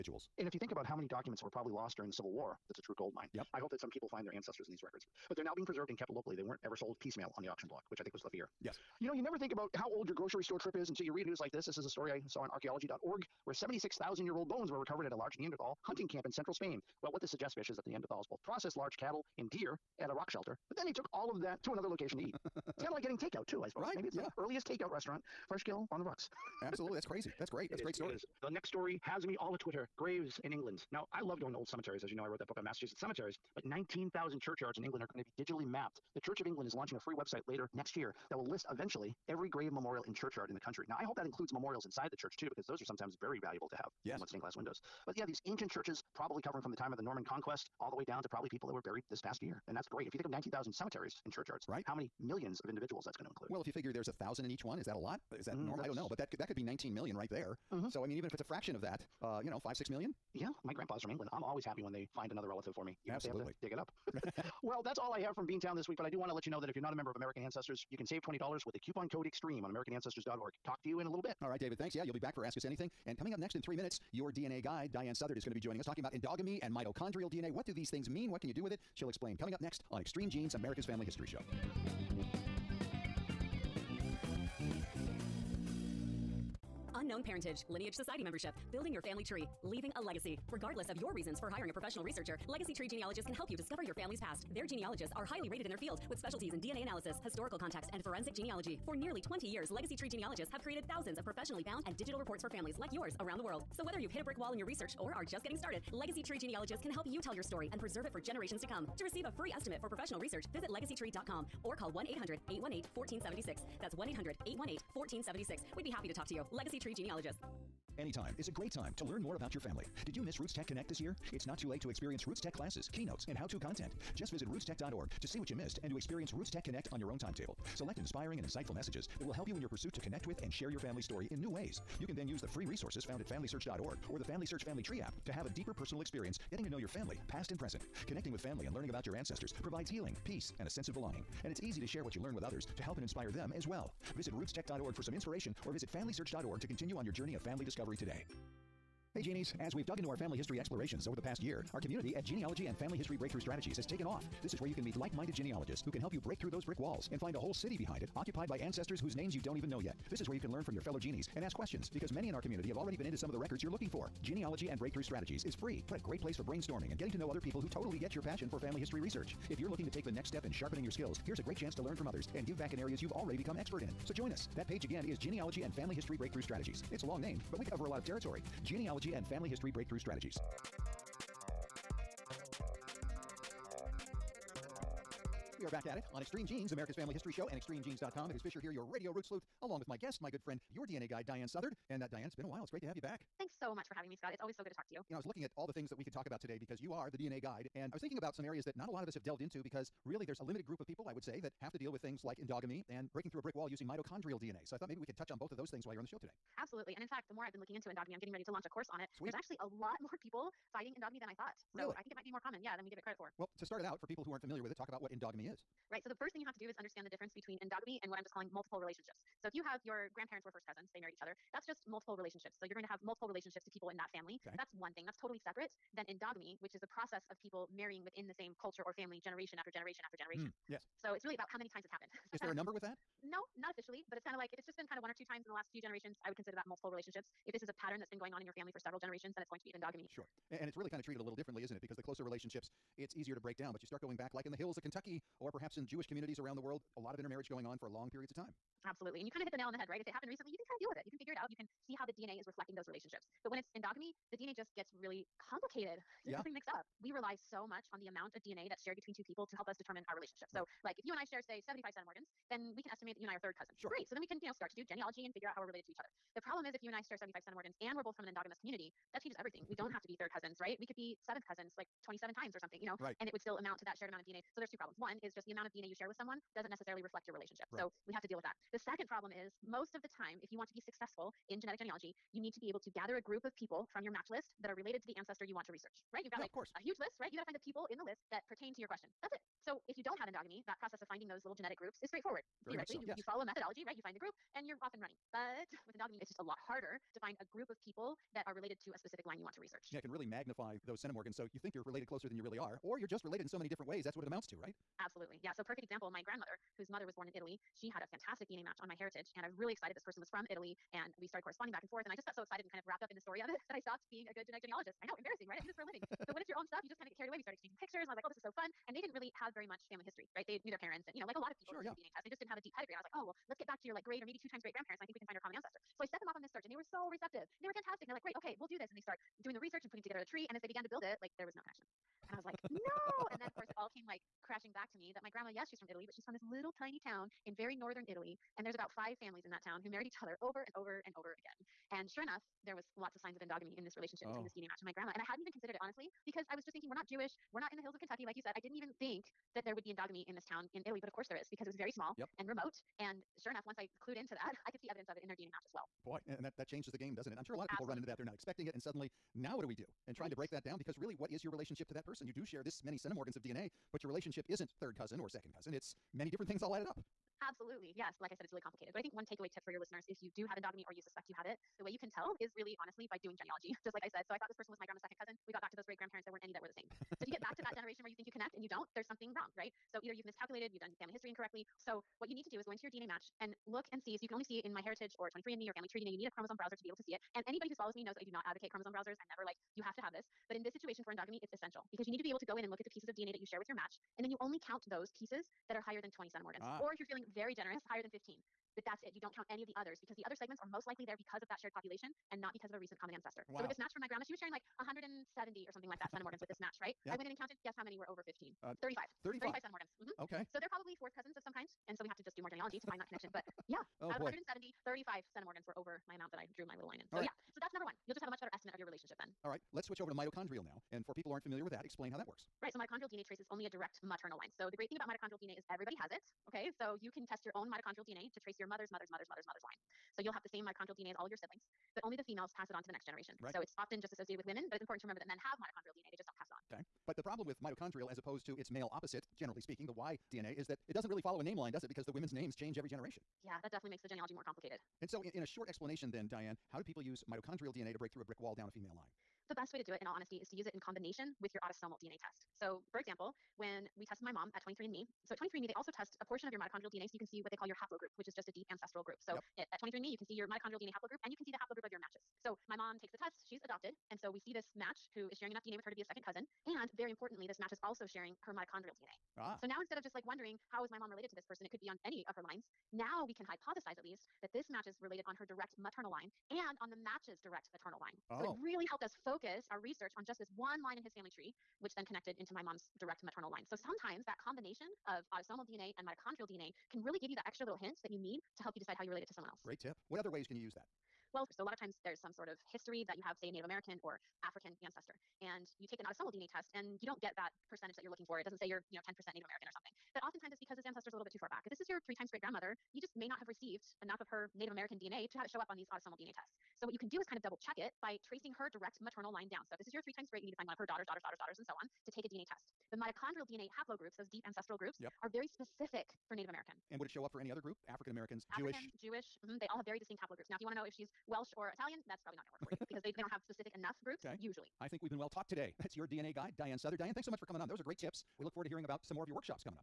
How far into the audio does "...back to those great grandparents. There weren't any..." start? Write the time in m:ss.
6:15.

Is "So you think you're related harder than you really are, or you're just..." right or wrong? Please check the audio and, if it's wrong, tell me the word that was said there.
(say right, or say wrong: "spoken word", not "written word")
wrong: "closer", not "harder".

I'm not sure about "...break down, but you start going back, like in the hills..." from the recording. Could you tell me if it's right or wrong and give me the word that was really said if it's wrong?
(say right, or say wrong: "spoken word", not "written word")
right.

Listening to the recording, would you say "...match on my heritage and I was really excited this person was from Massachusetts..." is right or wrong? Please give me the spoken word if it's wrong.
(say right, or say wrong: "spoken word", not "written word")
wrong: "Italy", not "Massachusetts".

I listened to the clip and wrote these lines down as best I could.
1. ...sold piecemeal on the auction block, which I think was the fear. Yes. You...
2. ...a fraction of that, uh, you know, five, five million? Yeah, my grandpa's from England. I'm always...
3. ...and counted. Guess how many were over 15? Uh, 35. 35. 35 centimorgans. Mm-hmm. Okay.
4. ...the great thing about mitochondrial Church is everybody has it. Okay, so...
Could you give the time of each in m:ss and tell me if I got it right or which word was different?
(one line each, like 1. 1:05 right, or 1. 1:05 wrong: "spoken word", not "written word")
1. 0:06 right
2. 0:58 wrong: "six", not "five"
3. 6:47 right
4. 7:04 wrong: "DNA", not "Church".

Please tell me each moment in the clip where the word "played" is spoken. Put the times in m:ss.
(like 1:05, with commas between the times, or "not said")
not said.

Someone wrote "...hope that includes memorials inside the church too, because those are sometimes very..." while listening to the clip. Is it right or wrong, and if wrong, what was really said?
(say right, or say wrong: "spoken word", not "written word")
right.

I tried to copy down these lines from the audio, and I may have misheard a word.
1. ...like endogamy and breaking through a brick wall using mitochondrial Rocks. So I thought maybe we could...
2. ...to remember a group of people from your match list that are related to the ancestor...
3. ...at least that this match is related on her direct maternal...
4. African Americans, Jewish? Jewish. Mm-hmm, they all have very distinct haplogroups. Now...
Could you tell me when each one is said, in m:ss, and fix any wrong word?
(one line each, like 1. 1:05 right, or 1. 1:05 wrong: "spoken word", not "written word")
1. 3:22 wrong: "DNA", not "Rocks"
2. 4:42 wrong: "gather", not "remember"
3. 7:53 right
4. 8:37 right.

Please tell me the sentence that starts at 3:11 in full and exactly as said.
And uh, Diahan, it's been a while.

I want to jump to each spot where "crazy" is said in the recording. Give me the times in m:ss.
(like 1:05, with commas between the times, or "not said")
0:27.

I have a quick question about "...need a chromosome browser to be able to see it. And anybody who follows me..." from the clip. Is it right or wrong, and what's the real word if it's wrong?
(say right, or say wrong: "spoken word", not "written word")
right.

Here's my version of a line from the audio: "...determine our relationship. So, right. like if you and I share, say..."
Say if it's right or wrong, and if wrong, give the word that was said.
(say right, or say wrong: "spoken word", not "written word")
right.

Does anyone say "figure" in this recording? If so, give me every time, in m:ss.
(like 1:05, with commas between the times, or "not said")
0:53, 4:11, 4:25.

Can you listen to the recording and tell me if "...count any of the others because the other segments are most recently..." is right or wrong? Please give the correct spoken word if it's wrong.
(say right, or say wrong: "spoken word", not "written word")
wrong: "likely", not "recently".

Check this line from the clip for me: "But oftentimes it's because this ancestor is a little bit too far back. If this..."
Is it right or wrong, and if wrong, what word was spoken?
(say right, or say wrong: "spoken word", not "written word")
right.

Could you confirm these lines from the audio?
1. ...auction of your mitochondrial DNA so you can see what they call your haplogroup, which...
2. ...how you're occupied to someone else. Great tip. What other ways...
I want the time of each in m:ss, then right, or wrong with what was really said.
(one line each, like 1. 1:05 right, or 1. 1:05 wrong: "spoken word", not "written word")
1. 7:36 wrong: "portion", not "auction"
2. 8:08 wrong: "related", not "occupied".